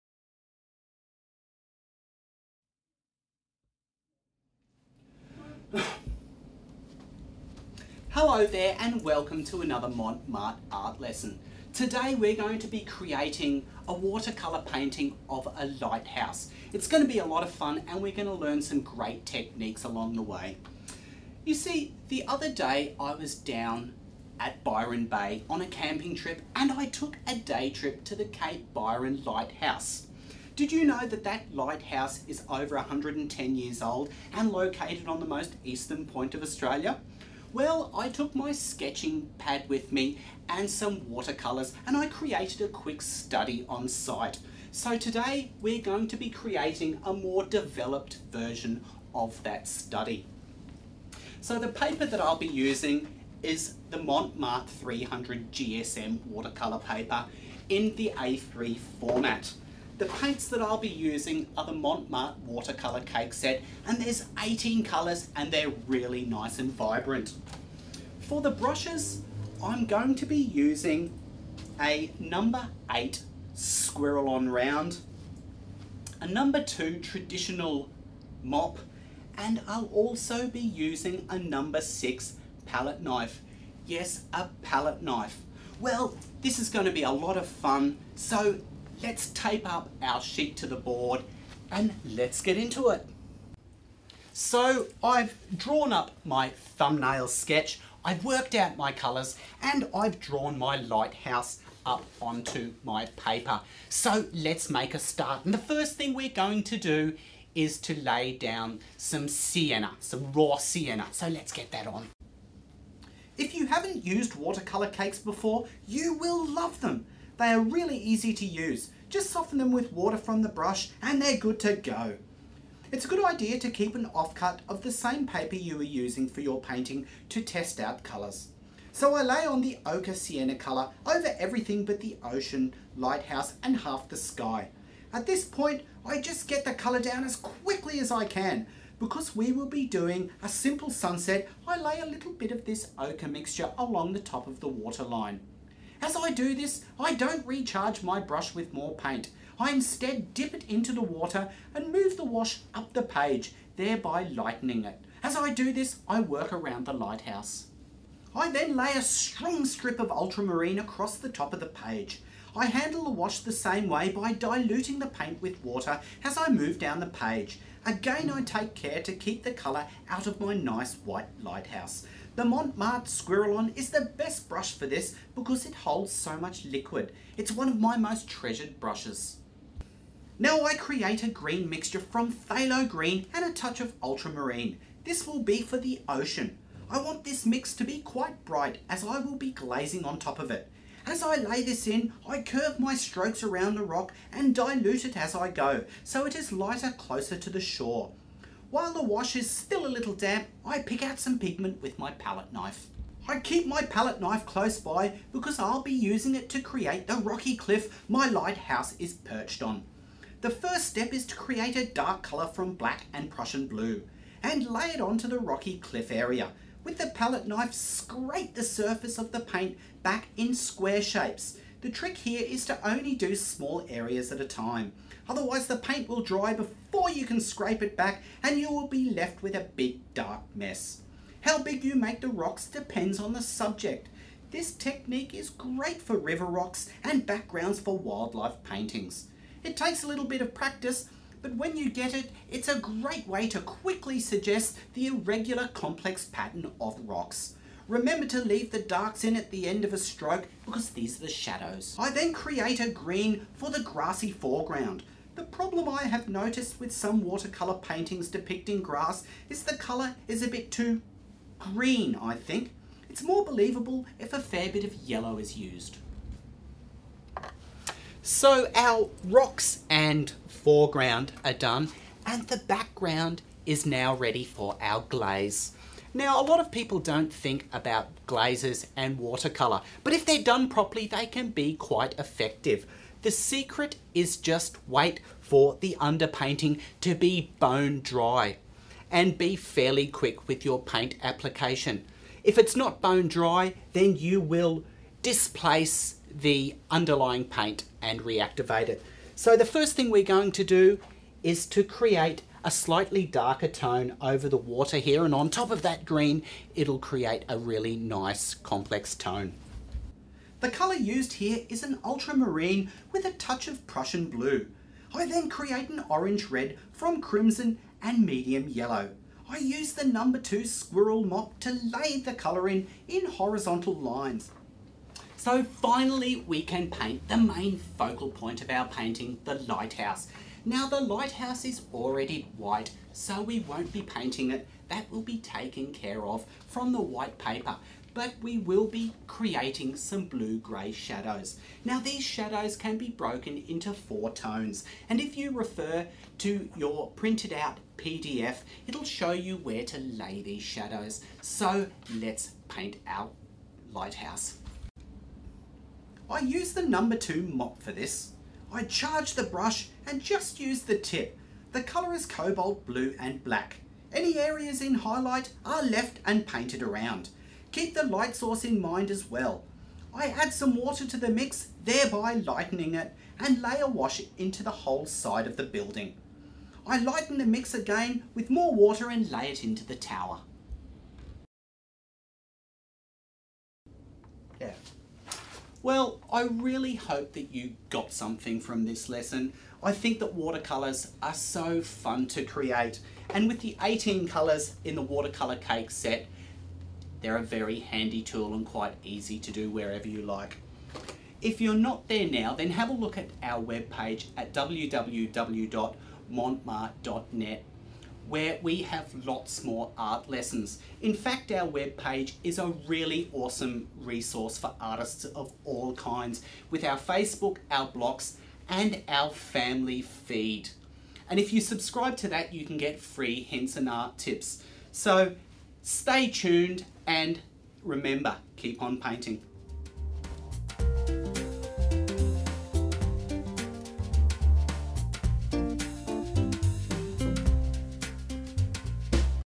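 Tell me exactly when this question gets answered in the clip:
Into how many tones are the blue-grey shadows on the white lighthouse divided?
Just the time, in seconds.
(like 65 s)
343 s.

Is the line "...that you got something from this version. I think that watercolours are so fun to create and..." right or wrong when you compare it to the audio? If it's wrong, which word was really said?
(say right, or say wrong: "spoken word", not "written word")
wrong: "lesson", not "version".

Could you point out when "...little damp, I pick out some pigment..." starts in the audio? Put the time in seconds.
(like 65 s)
199 s.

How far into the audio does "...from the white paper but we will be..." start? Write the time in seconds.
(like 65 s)
336 s.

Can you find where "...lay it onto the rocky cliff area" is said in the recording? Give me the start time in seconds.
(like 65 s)
214 s.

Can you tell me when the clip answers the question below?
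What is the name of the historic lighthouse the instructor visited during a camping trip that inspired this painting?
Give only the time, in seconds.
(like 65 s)
28 s.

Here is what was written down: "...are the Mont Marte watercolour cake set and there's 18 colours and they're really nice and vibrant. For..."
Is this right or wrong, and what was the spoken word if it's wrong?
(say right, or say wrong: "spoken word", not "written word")
right.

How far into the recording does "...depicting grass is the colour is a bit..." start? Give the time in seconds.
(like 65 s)
258 s.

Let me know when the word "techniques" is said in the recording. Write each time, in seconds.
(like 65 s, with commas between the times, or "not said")
19 s, 234 s.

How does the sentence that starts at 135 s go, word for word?
At this point, I just get the colour down as quickly as I can.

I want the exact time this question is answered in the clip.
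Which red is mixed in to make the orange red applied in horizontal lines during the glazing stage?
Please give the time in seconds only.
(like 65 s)
317 s.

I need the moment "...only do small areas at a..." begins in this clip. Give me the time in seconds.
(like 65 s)
222 s.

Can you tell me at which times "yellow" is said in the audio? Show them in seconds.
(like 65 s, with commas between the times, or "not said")
264 s, 318 s.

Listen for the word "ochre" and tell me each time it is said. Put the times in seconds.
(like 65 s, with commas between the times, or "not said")
129 s, 142 s.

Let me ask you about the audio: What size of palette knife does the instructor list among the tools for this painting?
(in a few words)
number 6.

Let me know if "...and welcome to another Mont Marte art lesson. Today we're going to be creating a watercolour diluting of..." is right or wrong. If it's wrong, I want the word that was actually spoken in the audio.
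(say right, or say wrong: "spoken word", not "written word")
wrong: "painting", not "diluting".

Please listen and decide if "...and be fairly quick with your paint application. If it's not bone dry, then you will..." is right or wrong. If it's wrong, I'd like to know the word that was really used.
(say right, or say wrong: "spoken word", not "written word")
right.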